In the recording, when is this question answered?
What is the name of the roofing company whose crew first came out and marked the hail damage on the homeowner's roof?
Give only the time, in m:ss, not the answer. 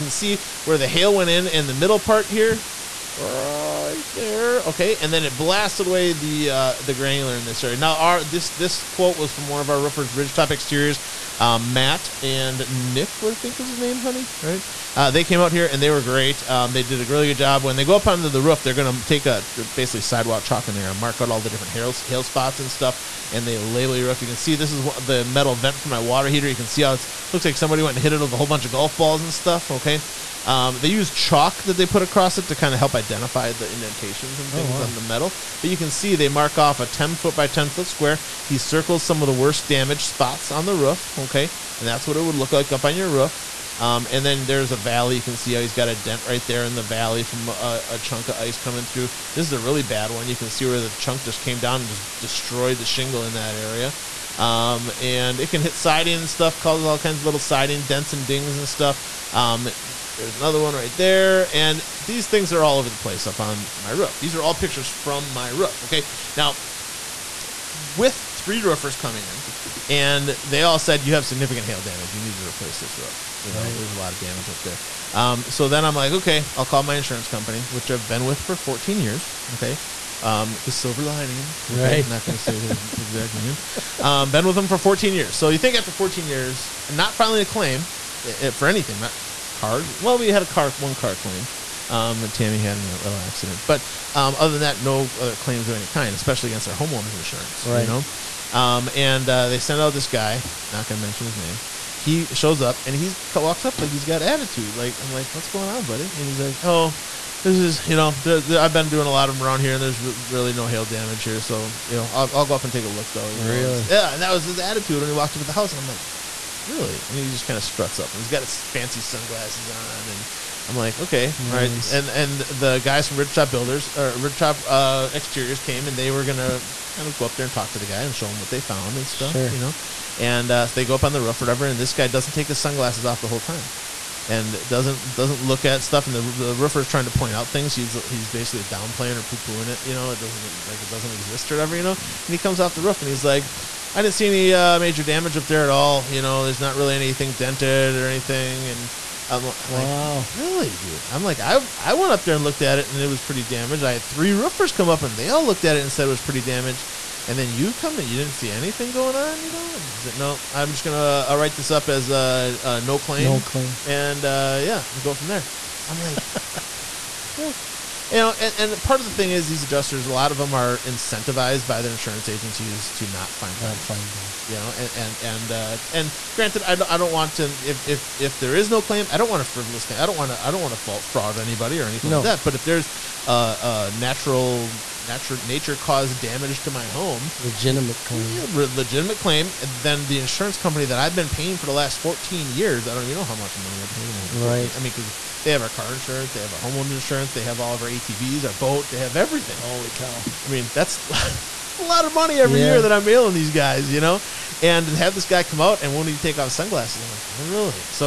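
0:10.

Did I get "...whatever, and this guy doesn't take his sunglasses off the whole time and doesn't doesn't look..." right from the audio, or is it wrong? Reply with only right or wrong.
right.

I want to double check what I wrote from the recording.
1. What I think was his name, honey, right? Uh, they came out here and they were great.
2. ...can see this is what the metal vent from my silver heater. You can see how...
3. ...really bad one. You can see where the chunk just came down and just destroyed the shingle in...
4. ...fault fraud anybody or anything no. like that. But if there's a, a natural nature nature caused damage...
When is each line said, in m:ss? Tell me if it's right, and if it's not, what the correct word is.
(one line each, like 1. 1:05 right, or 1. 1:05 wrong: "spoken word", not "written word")
1. 0:13 right
2. 0:24 wrong: "water", not "silver"
3. 0:49 right
4. 3:00 right.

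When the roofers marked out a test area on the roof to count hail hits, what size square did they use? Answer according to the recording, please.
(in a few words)
10 foot by 10 foot.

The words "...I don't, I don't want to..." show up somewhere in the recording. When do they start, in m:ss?
2:56.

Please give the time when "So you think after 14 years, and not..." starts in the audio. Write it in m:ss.
1:25.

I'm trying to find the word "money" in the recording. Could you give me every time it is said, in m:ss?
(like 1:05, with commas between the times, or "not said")
3:13, 3:22.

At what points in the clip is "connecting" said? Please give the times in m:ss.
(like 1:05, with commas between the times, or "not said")
not said.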